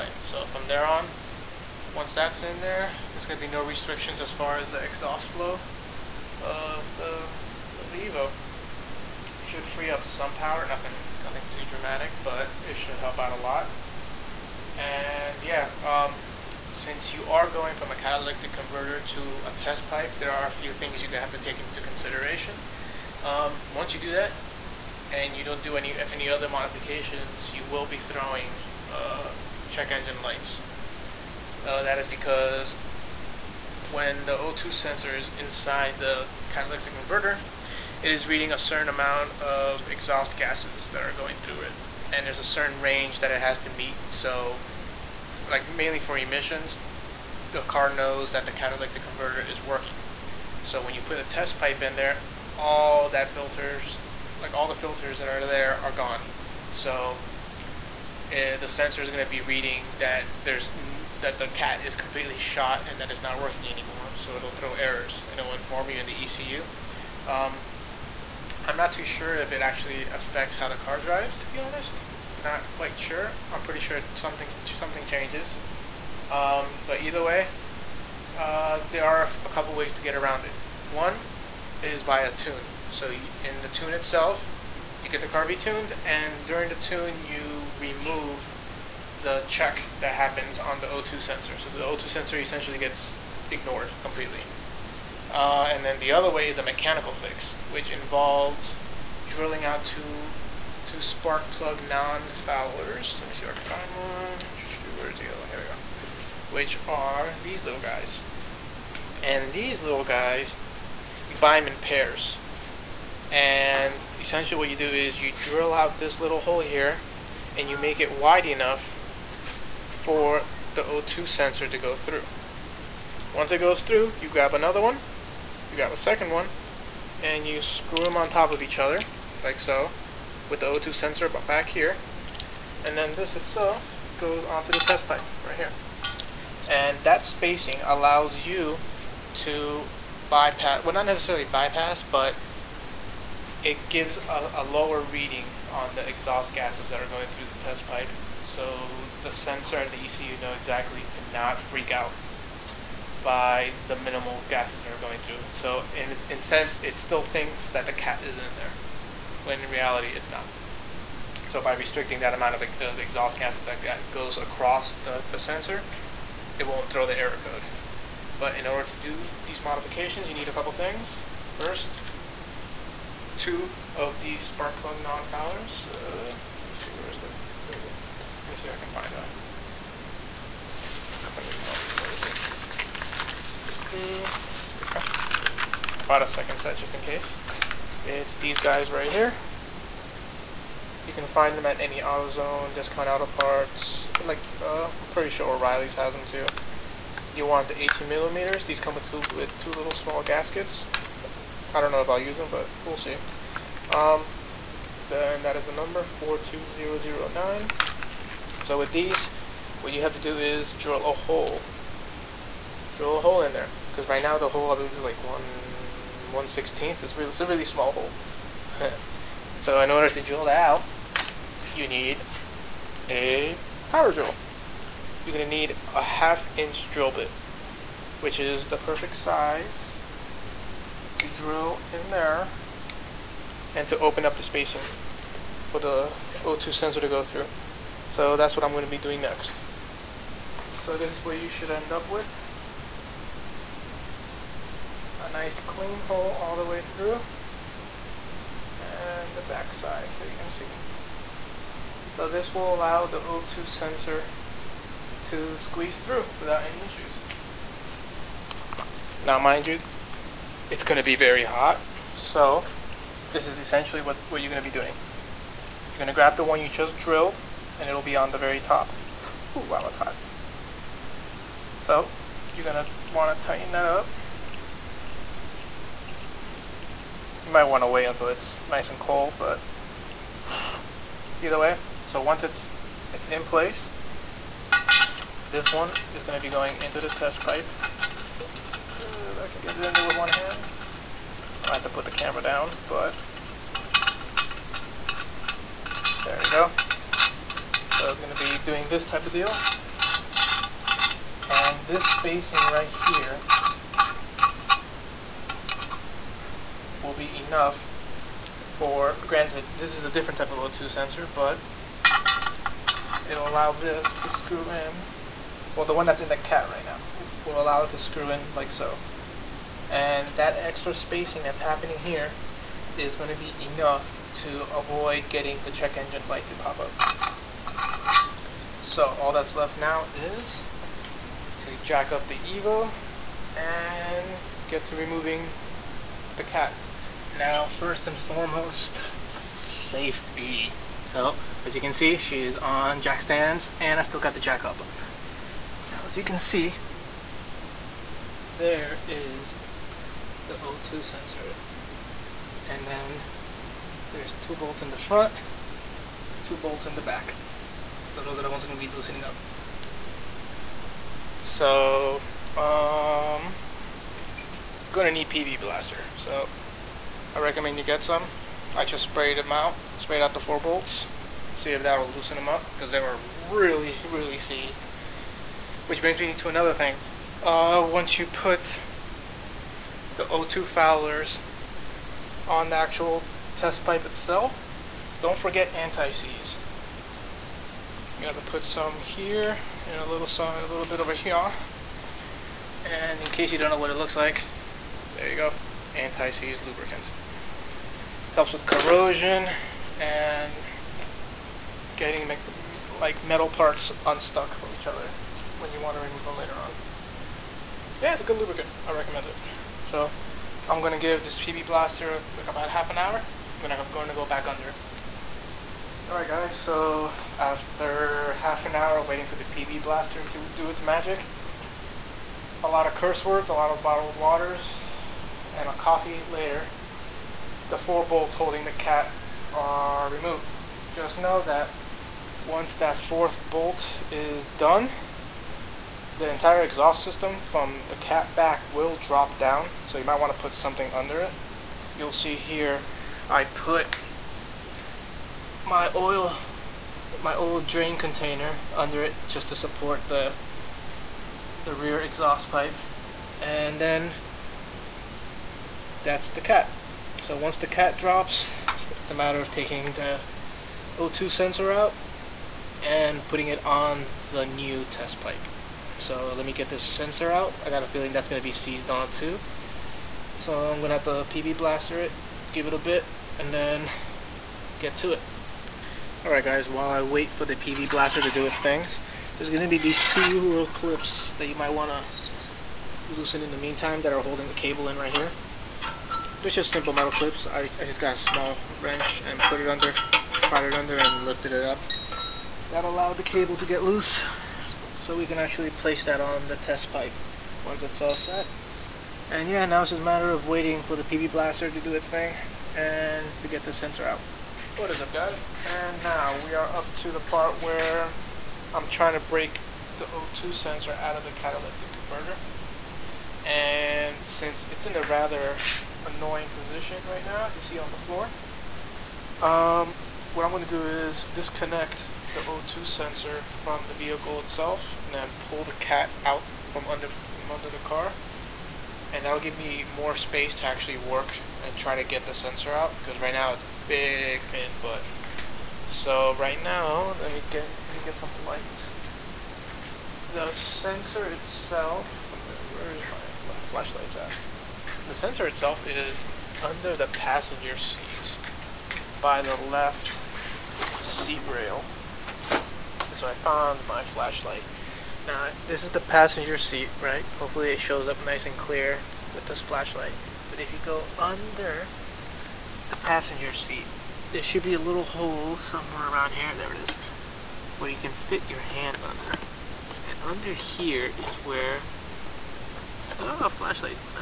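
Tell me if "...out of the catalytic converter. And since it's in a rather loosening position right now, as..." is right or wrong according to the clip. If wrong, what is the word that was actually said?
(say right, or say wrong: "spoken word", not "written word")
wrong: "annoying", not "loosening".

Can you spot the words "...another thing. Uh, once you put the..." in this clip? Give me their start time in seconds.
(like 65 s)
376 s.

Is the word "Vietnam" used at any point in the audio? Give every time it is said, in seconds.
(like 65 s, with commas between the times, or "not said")
not said.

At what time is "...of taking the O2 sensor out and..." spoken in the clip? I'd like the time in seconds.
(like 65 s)
459 s.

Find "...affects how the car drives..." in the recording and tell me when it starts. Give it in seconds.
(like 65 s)
70 s.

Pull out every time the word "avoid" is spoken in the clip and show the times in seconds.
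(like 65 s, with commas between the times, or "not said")
324 s.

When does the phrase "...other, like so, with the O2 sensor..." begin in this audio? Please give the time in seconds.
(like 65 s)
128 s.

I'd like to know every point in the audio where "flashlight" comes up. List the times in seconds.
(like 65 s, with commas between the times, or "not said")
543 s, 554 s, 559 s, 573 s.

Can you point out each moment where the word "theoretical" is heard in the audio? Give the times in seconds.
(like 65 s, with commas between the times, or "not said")
not said.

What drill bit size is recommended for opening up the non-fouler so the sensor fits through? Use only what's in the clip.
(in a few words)
half inch.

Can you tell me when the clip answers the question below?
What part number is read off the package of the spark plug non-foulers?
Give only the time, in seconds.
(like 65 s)
206 s.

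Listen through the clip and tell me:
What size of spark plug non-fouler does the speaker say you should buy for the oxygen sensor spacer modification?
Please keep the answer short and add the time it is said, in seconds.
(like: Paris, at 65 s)
18 millimeters, at 197 s.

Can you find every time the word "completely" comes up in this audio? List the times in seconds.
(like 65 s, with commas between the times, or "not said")
61 s, 93 s.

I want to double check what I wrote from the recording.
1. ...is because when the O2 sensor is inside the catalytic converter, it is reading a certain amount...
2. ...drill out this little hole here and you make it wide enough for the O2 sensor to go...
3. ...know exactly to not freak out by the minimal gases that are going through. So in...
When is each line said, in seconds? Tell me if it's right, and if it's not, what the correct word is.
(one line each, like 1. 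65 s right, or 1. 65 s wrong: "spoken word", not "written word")
1. 31 s right
2. 115 s right
3. 150 s right.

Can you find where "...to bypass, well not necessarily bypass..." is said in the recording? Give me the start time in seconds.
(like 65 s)
139 s.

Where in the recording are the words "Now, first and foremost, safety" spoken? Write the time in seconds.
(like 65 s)
337 s.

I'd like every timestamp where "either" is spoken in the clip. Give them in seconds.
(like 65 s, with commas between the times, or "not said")
77 s, 281 s.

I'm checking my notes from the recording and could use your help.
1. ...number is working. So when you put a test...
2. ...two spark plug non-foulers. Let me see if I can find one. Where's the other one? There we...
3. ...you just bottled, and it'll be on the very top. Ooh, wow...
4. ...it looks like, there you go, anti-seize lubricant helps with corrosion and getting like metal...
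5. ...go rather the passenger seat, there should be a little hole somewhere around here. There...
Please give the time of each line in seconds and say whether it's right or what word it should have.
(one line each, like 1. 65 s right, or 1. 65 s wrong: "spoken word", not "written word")
1. 49 s wrong: "converter", not "number"
2. 100 s right
3. 266 s wrong: "drilled", not "bottled"
4. 393 s right
5. 560 s wrong: "under", not "rather".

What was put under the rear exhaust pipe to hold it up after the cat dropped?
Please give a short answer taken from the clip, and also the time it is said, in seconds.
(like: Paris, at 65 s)
old drain container, at 447 s.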